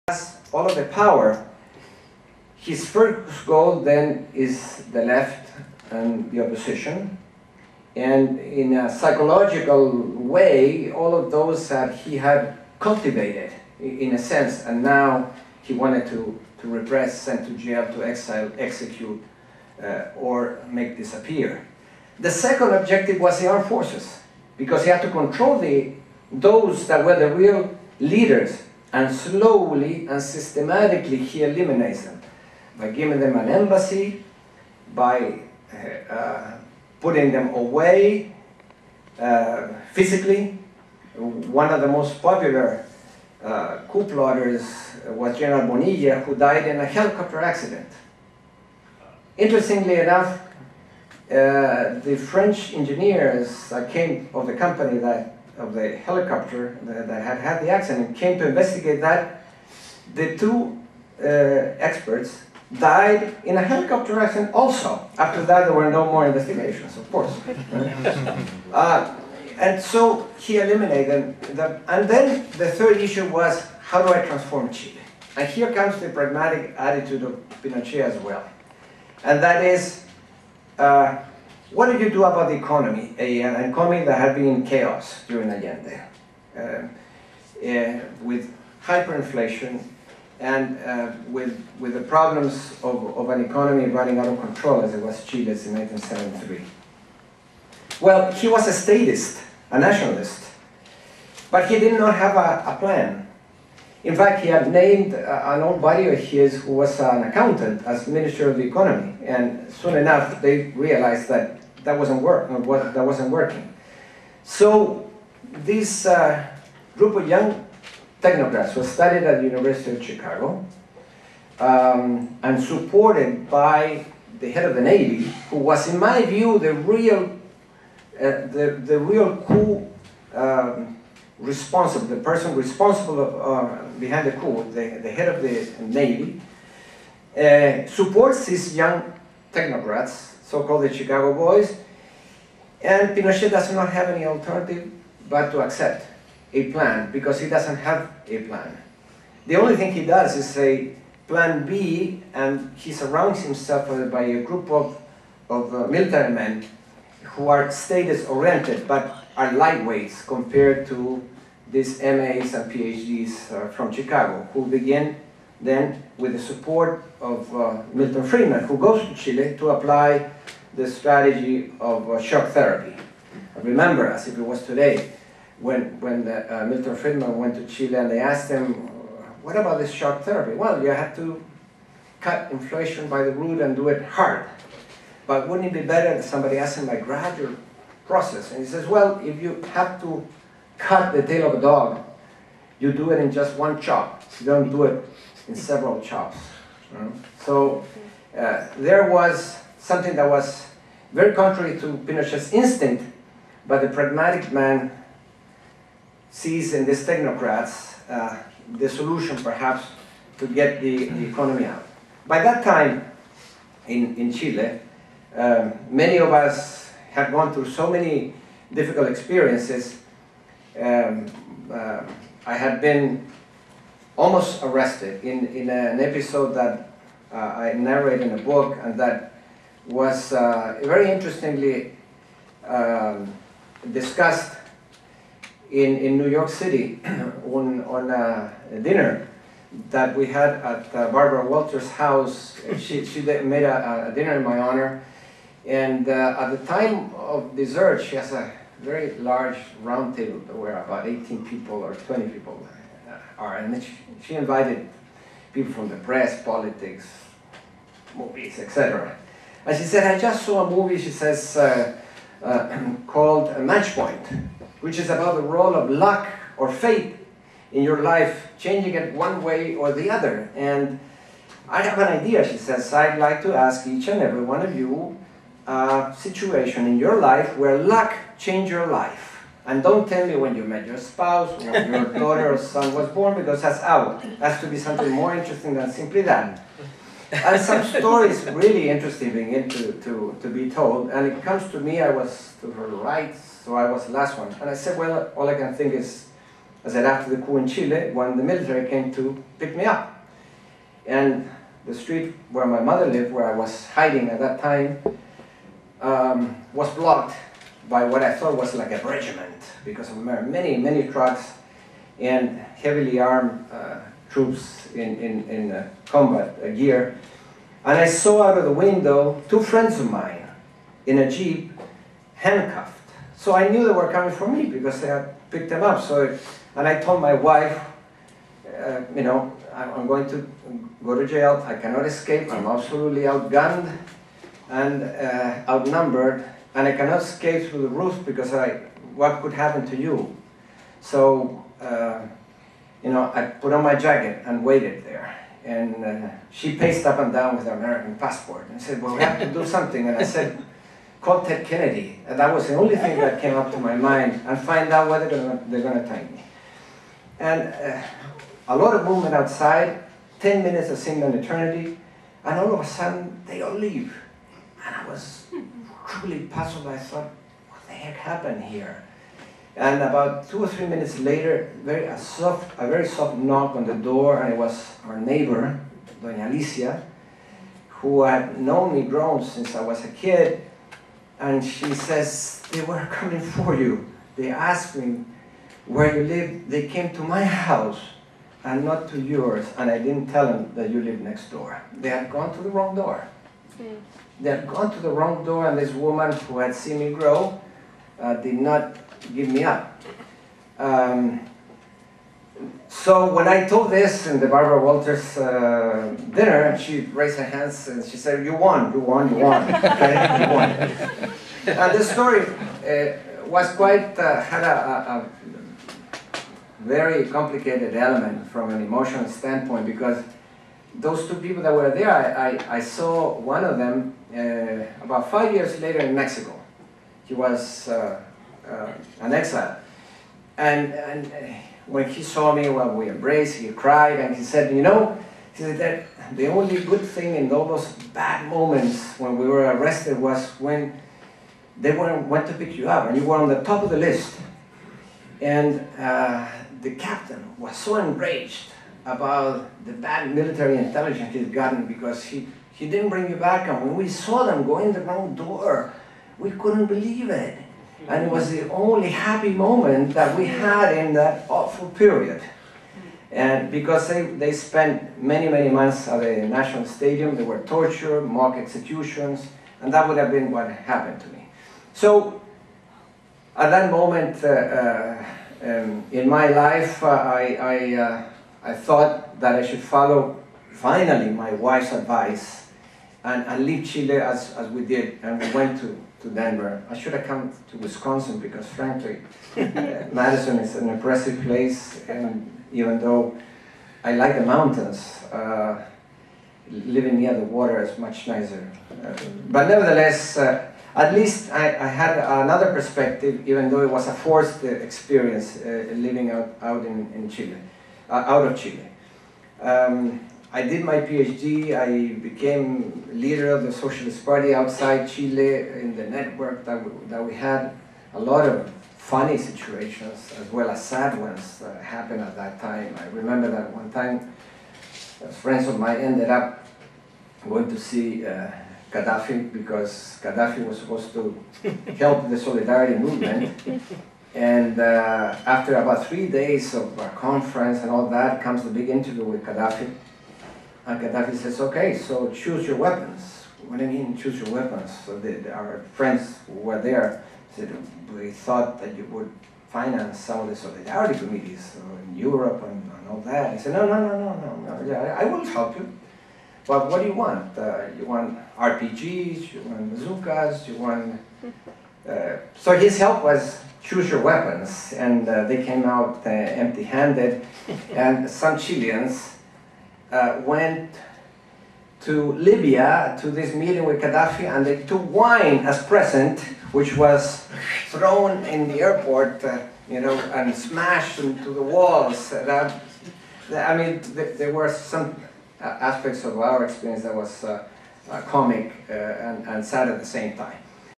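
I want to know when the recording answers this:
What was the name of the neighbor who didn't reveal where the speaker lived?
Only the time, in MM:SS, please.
06:16.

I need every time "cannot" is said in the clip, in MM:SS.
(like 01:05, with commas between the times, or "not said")
05:31, 05:36.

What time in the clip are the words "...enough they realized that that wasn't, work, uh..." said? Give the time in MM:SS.
01:49.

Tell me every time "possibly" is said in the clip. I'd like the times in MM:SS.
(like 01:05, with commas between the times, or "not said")
not said.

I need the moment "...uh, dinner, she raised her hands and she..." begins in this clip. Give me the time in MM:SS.
06:45.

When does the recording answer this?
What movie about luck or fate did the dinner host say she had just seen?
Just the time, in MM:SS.
04:23.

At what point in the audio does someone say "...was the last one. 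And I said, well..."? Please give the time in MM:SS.
04:53.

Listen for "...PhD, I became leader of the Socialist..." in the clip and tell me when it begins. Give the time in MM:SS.
08:30.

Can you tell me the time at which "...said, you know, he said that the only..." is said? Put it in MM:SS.
07:14.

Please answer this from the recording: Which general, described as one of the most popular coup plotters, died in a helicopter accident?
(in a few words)
General Bonilla.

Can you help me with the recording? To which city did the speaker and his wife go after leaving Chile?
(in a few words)
Denver.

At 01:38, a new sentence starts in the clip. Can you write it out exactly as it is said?
Well, he was a statist, a nationalist, but he did not have a, a plan.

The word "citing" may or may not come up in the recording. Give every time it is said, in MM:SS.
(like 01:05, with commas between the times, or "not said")
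not said.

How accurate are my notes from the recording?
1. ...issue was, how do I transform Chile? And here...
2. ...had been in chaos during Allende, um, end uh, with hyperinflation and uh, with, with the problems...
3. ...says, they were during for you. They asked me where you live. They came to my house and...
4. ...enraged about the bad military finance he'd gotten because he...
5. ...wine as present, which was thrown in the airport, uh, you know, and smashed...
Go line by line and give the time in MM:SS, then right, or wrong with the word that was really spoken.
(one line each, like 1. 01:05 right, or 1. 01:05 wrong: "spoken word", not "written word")
1. 01:12 right
2. 01:24 right
3. 06:21 wrong: "coming", not "during"
4. 07:27 wrong: "intelligence", not "finance"
5. 09:35 right.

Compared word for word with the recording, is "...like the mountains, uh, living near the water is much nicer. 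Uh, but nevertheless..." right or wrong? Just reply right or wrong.
right.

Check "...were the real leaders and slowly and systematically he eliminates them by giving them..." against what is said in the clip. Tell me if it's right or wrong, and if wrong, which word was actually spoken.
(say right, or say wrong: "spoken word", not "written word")
right.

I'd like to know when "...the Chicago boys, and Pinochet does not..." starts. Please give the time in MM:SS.
02:20.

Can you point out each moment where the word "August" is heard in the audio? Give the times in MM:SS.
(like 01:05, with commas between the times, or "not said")
not said.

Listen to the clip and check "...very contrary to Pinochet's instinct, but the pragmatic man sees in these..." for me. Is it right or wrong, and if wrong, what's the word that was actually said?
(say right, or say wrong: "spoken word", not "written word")
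right.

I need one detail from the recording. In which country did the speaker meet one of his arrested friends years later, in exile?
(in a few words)
Mexico.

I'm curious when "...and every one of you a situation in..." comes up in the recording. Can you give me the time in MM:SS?
04:34.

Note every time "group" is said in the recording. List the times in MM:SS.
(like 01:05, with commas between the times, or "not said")
01:56, 02:34.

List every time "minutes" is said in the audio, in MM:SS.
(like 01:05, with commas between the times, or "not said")
06:00, 06:10.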